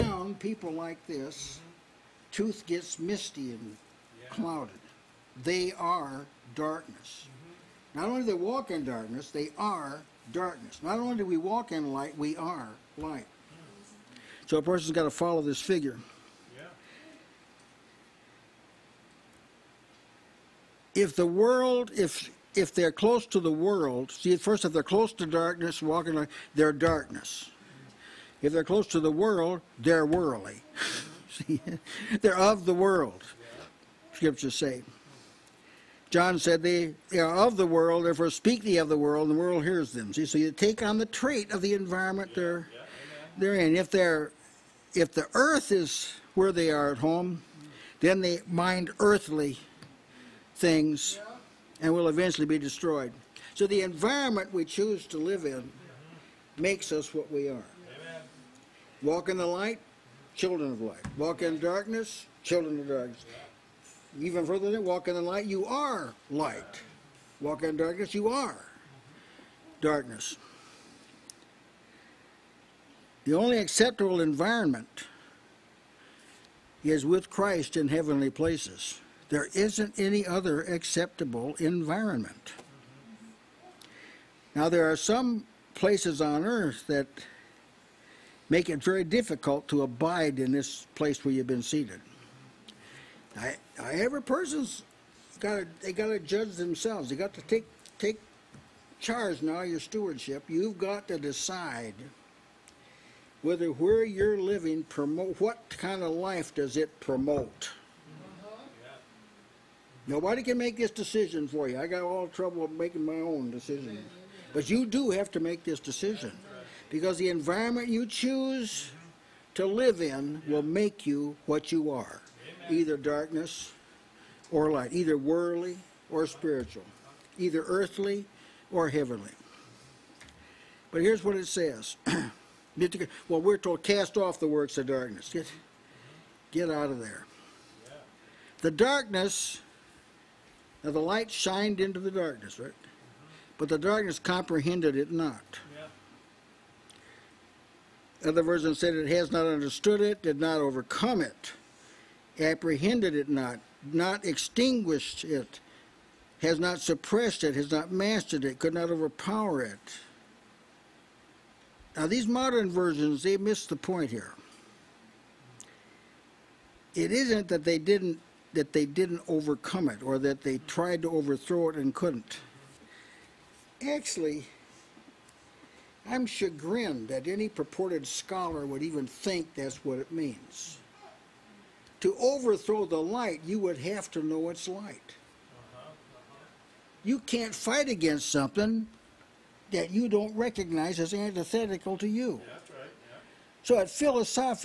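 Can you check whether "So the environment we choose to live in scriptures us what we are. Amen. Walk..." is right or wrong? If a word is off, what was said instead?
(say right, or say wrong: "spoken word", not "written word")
wrong: "makes", not "scriptures".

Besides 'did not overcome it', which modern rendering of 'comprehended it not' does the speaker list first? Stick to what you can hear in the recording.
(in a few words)
has not understood it.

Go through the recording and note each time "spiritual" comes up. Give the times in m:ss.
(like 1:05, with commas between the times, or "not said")
2:06.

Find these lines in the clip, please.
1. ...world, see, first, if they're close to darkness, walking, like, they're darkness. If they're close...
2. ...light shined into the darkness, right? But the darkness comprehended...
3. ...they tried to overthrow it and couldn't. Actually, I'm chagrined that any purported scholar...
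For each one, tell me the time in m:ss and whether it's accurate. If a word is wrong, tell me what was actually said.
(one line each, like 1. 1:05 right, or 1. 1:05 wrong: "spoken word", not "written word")
1. 0:23 right
2. 2:20 right
3. 2:50 right.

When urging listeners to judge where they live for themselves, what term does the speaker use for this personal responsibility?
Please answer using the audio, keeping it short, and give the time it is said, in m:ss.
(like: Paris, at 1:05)
stewardship, at 1:39.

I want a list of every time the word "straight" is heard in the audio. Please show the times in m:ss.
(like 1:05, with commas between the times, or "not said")
not said.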